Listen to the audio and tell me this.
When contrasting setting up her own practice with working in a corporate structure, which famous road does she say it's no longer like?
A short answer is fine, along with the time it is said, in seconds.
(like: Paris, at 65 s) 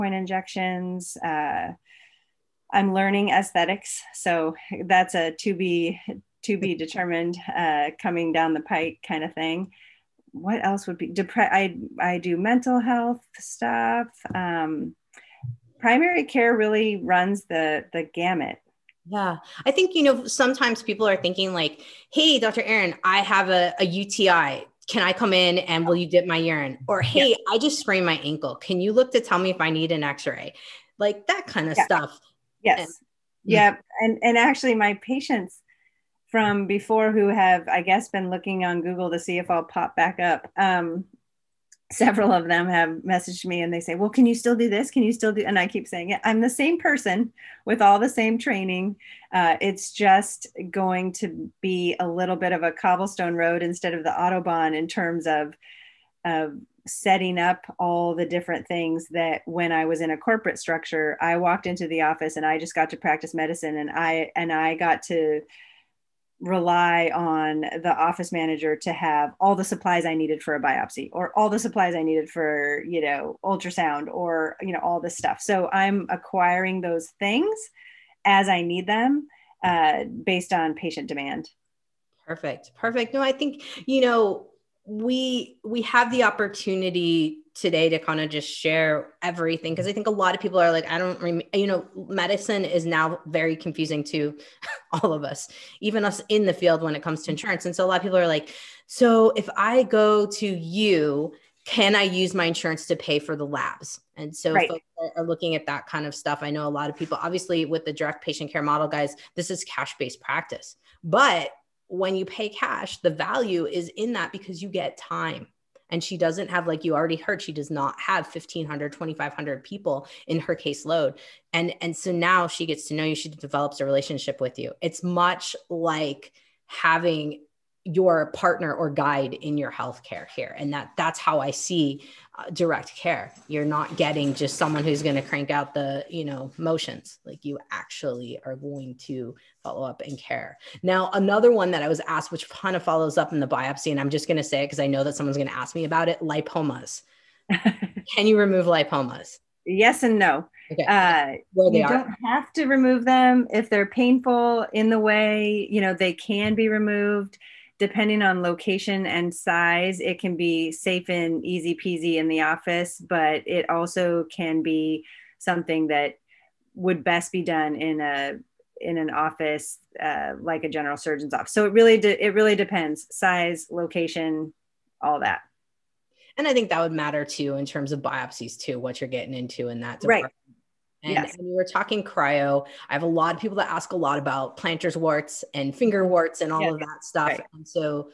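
Autobahn, at 54 s.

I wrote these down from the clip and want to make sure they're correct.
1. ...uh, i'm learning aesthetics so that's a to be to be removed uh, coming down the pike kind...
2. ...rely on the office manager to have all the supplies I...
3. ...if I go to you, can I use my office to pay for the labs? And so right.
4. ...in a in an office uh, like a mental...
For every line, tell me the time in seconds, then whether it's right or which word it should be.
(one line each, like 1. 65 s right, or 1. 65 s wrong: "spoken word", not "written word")
1. 1 s wrong: "determined", not "removed"
2. 66 s right
3. 99 s wrong: "insurance", not "office"
4. 167 s wrong: "general", not "mental".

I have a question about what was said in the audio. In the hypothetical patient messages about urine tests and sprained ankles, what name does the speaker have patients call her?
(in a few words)
Dr. 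Erin.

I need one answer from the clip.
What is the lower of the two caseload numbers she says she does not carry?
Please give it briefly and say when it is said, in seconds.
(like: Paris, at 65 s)
1500, at 118 s.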